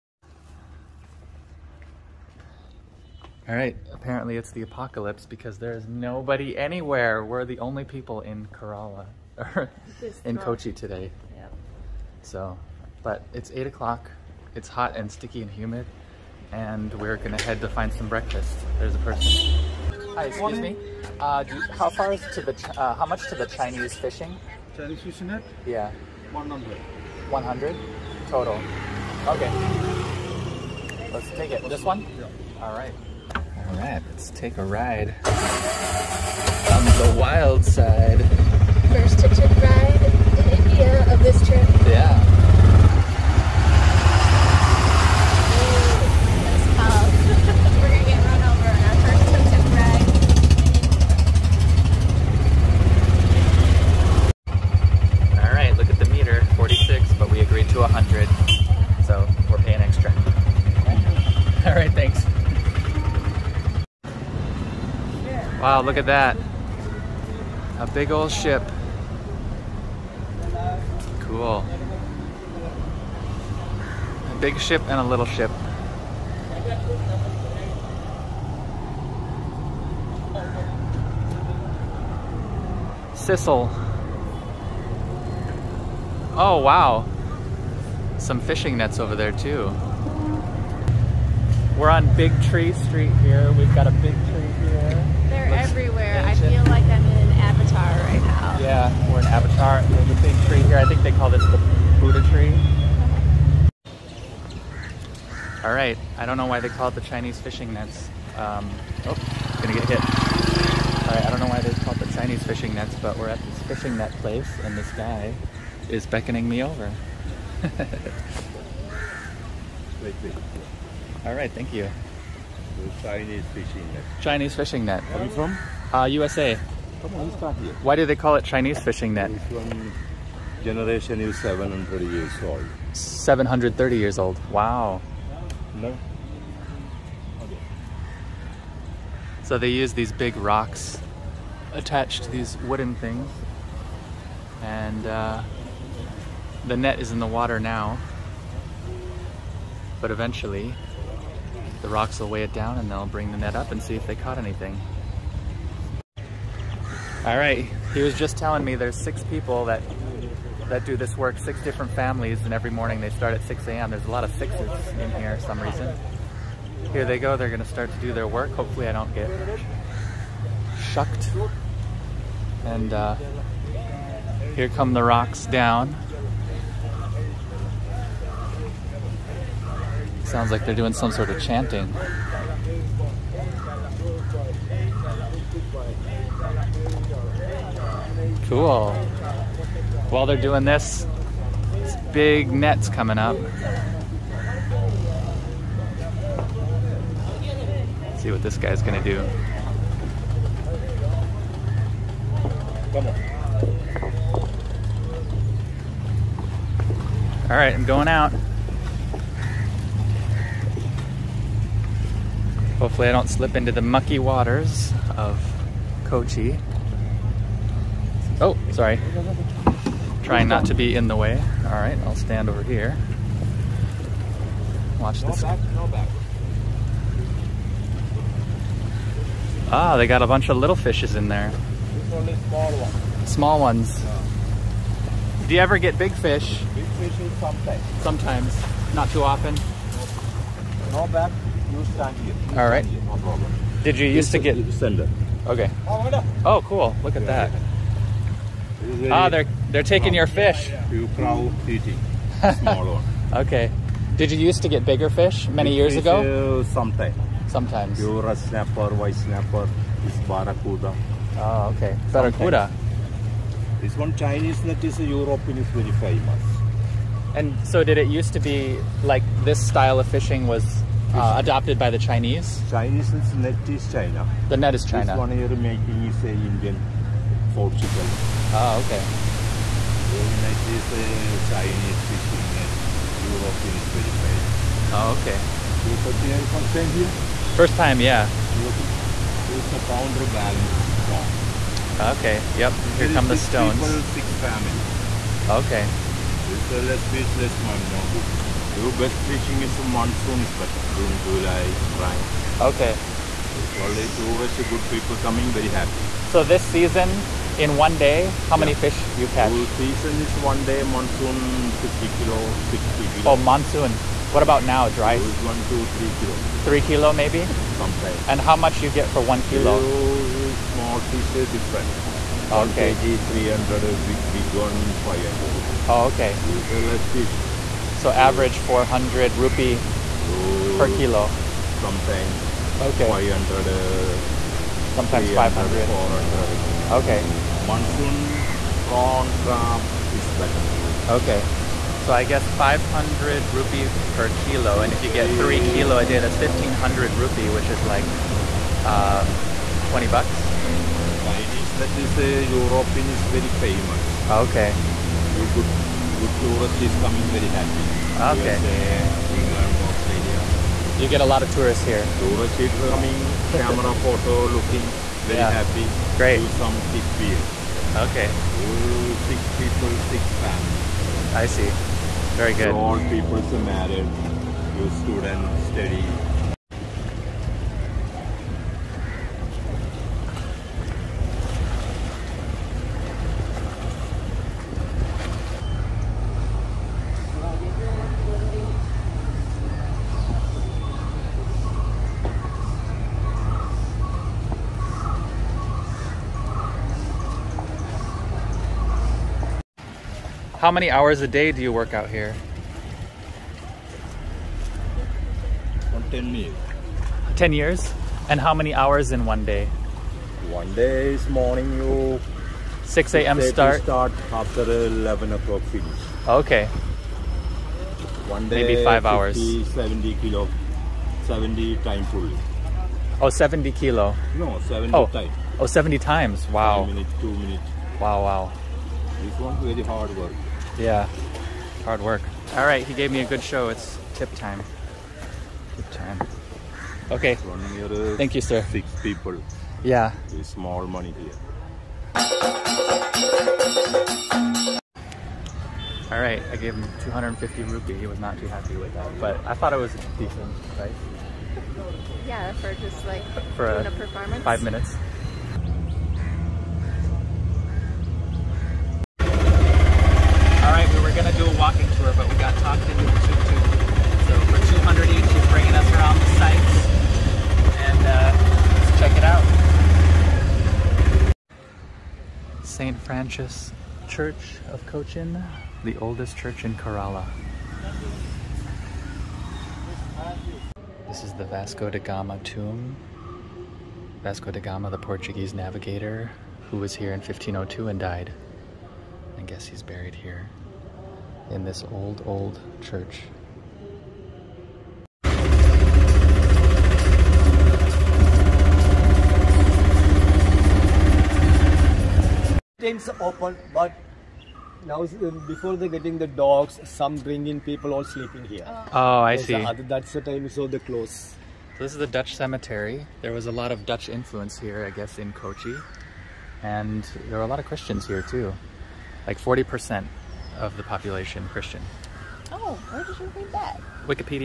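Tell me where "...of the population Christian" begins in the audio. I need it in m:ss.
8:40.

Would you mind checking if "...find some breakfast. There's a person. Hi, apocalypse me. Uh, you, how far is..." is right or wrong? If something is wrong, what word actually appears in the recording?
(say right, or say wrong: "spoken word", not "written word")
wrong: "excuse", not "apocalypse".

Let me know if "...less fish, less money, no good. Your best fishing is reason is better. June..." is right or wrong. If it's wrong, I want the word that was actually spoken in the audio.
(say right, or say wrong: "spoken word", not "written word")
wrong: "monsoon", not "reason".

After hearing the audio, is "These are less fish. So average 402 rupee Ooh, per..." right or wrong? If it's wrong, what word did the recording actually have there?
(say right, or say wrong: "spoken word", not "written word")
wrong: "400", not "402".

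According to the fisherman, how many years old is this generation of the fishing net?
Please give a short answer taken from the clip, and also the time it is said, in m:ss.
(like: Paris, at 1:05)
730, at 2:12.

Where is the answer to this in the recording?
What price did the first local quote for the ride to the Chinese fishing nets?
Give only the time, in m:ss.
0:27.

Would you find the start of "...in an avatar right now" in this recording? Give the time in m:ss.
1:37.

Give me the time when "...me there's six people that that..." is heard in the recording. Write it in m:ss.
2:38.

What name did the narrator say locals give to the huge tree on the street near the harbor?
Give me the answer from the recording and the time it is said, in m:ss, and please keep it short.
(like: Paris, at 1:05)
Buddha tree, at 1:41.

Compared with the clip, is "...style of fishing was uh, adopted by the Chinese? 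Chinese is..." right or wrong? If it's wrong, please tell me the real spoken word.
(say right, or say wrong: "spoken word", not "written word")
right.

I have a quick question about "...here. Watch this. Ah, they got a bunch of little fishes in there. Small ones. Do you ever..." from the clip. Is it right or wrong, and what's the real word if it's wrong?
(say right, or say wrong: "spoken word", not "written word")
right.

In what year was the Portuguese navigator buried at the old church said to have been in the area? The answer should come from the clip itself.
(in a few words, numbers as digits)
1502.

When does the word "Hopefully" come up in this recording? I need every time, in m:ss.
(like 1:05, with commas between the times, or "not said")
2:48, 3:32.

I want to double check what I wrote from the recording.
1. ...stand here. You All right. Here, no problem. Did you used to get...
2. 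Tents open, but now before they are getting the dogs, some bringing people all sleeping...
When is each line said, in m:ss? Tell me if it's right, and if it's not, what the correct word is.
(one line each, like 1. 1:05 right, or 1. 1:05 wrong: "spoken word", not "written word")
1. 4:01 right
2. 8:22 right.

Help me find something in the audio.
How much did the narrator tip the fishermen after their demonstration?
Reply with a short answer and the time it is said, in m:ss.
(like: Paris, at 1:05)
250 rupee, at 7:27.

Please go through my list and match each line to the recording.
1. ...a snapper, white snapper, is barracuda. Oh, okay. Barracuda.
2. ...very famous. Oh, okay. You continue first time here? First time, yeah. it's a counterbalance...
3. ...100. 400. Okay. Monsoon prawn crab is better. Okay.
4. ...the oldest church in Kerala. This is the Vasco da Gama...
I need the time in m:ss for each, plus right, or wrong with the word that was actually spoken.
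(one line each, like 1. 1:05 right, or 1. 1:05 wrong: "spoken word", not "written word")
1. 4:18 right
2. 4:43 right
3. 5:35 wrong: "500", not "100"
4. 7:55 right.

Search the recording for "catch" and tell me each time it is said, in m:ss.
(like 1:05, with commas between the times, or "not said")
5:09.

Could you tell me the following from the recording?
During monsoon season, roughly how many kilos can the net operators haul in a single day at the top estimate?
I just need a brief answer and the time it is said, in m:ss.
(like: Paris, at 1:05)
60 kilo, at 5:12.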